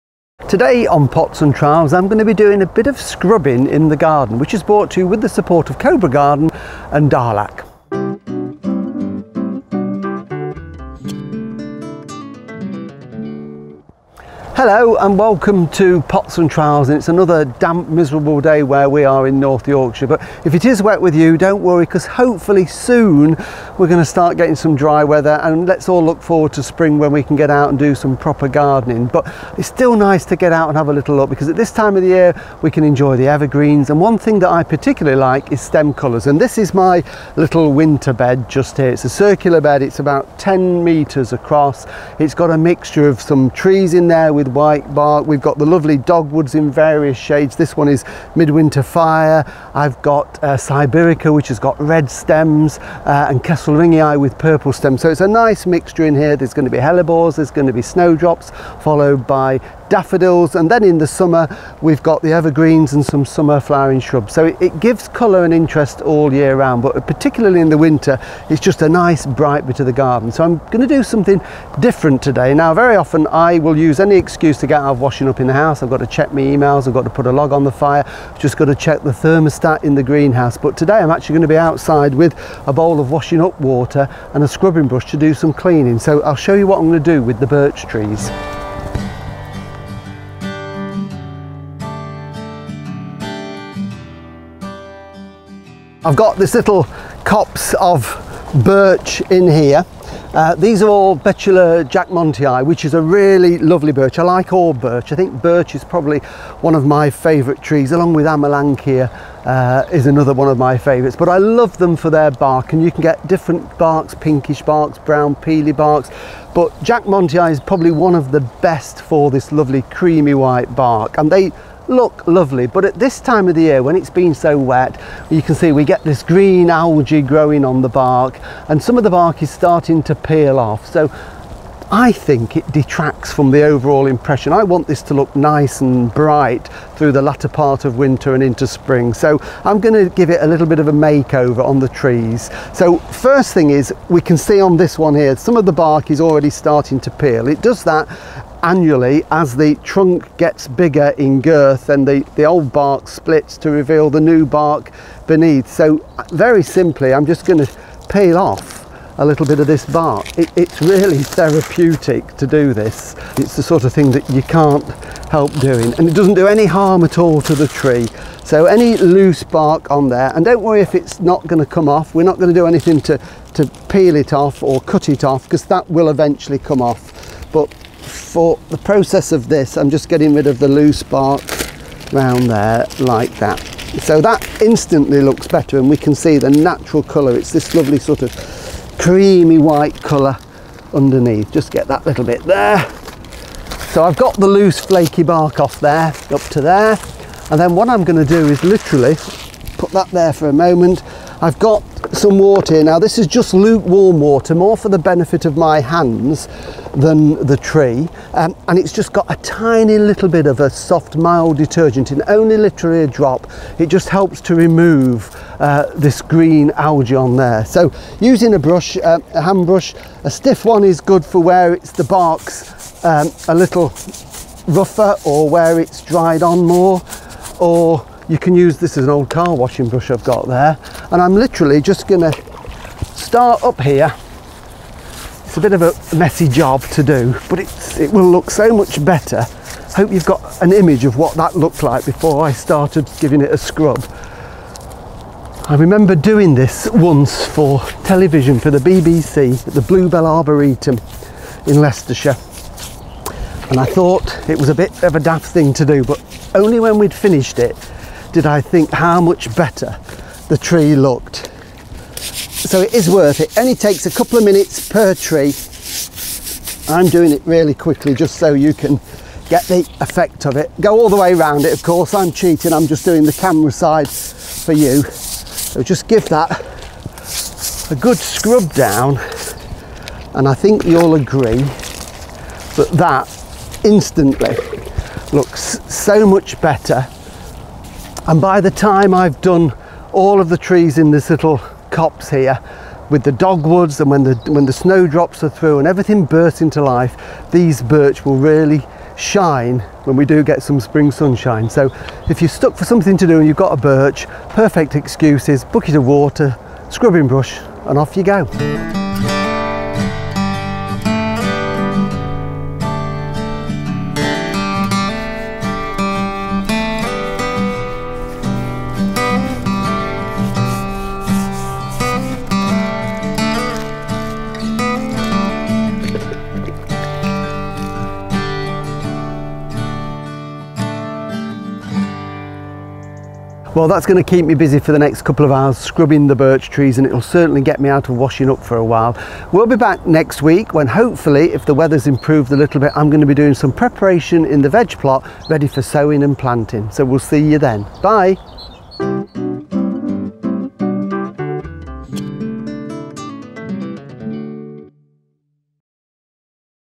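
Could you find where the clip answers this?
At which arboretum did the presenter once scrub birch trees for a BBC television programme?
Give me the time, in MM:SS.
04:09.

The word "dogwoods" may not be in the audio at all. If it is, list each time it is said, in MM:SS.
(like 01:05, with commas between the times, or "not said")
00:45, 04:53.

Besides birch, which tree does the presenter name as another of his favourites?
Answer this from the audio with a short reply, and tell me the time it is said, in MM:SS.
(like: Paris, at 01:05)
Amelanchier, at 01:48.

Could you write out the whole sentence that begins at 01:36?
I've got this little copse of birch in here.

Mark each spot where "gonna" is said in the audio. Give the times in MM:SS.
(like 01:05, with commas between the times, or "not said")
03:18, 03:52.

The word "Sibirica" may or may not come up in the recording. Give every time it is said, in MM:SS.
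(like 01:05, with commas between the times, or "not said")
00:50.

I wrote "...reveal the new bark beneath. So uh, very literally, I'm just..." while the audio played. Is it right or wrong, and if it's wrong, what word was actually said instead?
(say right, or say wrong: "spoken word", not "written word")
wrong: "simply", not "literally".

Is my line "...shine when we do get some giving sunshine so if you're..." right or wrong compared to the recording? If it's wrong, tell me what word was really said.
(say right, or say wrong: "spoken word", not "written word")
wrong: "spring", not "giving".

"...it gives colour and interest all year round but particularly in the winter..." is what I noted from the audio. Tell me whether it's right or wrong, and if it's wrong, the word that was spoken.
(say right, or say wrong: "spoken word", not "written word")
right.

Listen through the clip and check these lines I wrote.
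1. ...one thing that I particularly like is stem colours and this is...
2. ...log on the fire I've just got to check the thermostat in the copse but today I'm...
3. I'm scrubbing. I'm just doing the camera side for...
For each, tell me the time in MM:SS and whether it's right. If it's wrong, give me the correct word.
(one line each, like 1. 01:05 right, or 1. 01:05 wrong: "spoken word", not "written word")
1. 00:33 right
2. 01:17 wrong: "greenhouse", not "copse"
3. 04:32 wrong: "cheating", not "scrubbing".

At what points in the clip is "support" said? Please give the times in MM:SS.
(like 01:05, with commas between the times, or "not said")
00:05.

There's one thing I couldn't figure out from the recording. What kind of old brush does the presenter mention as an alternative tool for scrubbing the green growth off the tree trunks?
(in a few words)
car washing brush.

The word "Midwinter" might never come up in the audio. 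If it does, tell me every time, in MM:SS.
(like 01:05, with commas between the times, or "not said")
00:48.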